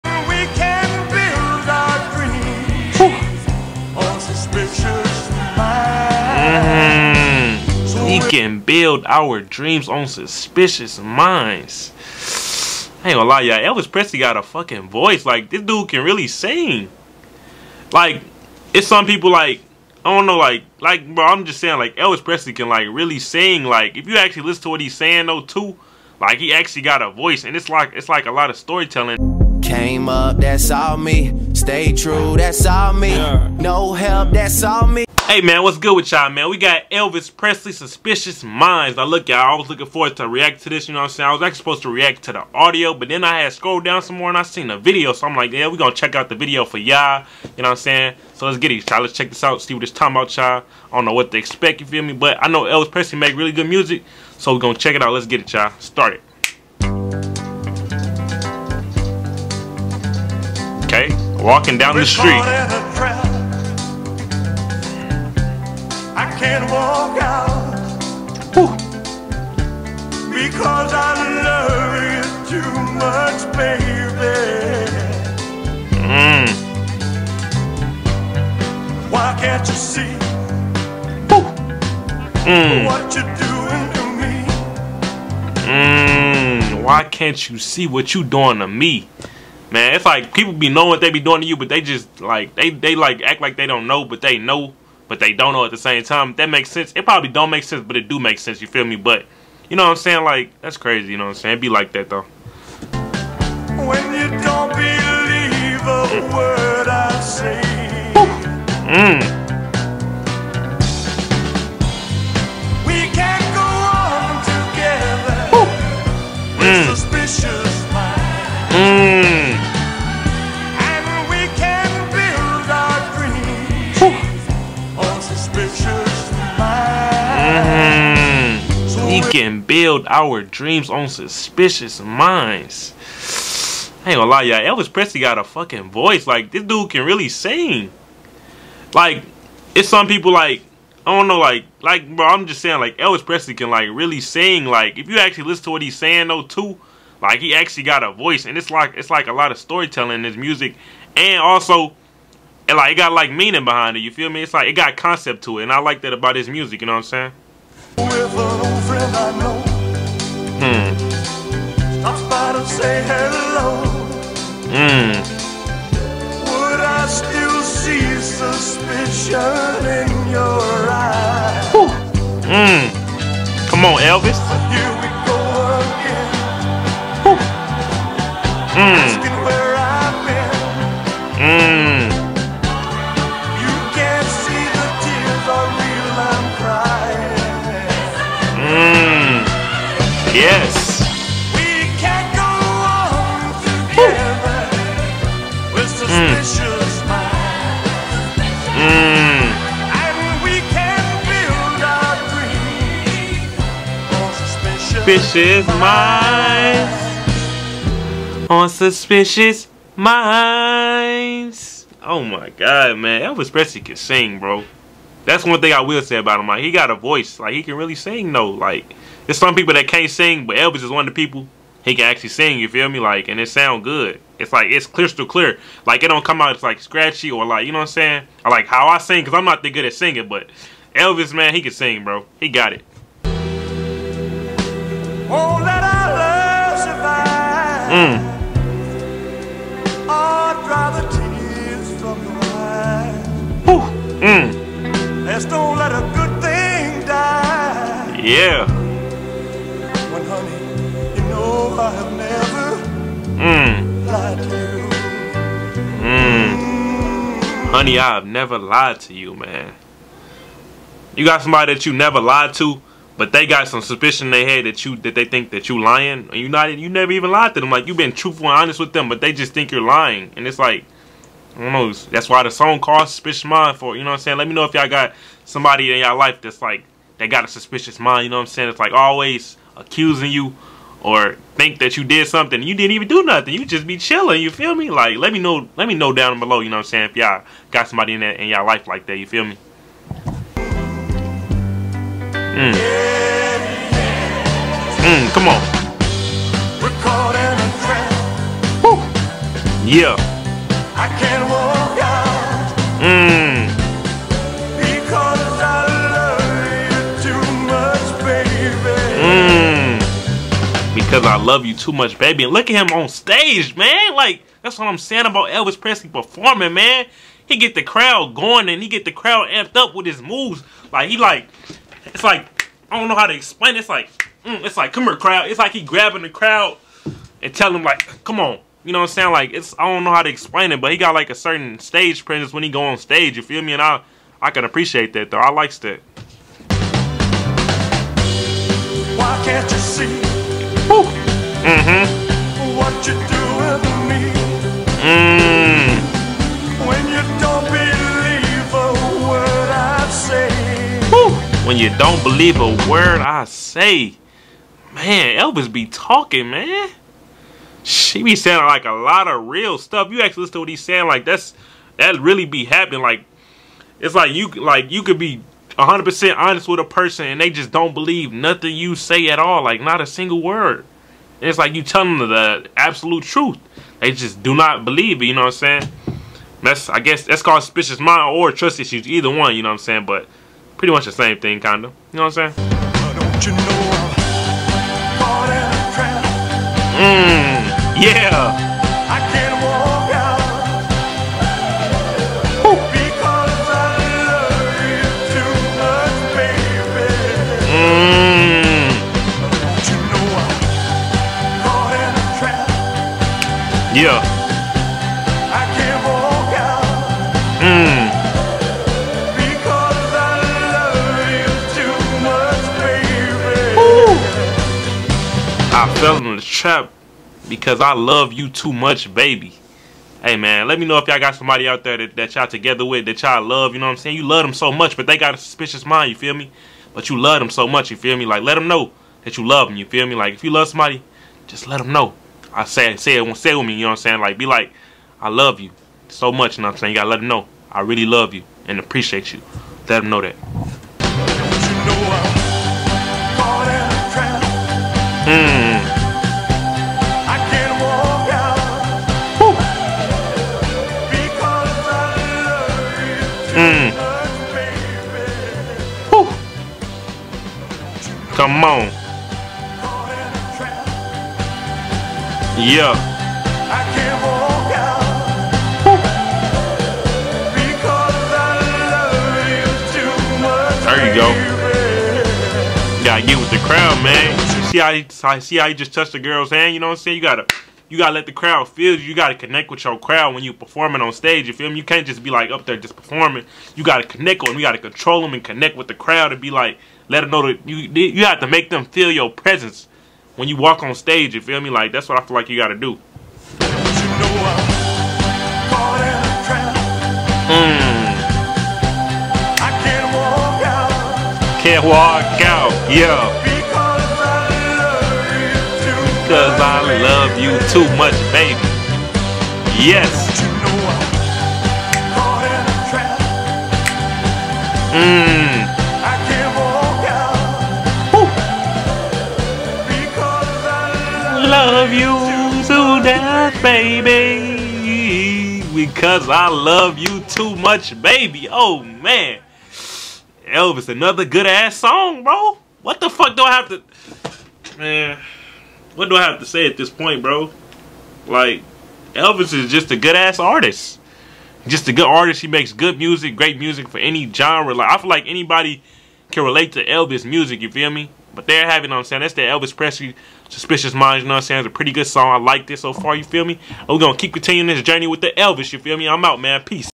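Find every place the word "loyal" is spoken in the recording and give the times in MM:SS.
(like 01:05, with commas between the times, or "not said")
not said.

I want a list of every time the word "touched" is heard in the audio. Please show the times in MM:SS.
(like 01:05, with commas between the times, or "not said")
07:55.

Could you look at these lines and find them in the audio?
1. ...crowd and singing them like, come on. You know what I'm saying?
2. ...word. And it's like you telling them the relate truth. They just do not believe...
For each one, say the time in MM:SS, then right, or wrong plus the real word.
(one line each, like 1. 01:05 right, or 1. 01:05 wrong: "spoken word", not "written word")
1. 05:26 wrong: "telling", not "singing"
2. 06:10 wrong: "absolute", not "relate".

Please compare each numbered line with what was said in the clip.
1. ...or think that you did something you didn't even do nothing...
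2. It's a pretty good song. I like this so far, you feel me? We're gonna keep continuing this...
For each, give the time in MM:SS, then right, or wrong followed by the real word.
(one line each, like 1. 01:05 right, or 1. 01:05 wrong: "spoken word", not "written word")
1. 04:41 right
2. 09:11 right.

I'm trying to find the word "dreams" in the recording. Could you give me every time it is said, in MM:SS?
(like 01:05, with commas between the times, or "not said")
00:09, 02:10.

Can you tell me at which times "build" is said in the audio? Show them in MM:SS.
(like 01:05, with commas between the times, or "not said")
00:08, 02:09.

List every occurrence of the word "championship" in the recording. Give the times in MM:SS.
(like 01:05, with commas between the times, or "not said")
not said.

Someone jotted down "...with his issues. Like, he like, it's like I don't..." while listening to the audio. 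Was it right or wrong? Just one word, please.
wrong.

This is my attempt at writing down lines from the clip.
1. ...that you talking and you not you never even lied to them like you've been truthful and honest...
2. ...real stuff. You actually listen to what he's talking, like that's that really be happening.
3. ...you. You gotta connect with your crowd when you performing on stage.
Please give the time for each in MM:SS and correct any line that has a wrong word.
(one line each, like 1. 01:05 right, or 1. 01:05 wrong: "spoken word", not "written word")
1. 04:25 wrong: "lying", not "talking"
2. 05:59 wrong: "saying", not "talking"
3. 07:58 right.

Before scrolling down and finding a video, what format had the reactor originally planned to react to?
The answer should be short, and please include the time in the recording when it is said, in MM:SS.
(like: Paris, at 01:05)
audio, at 00:42.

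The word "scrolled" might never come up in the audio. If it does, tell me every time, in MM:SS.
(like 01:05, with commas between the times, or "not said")
00:43.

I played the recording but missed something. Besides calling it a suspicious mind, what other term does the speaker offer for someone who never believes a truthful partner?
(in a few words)
trust issues.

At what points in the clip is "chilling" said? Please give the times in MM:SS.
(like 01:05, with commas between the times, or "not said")
04:43.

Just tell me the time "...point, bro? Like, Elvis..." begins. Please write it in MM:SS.
08:56.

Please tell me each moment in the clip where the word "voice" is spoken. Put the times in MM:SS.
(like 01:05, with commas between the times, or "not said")
00:14, 00:27, 02:15, 02:28, 03:36.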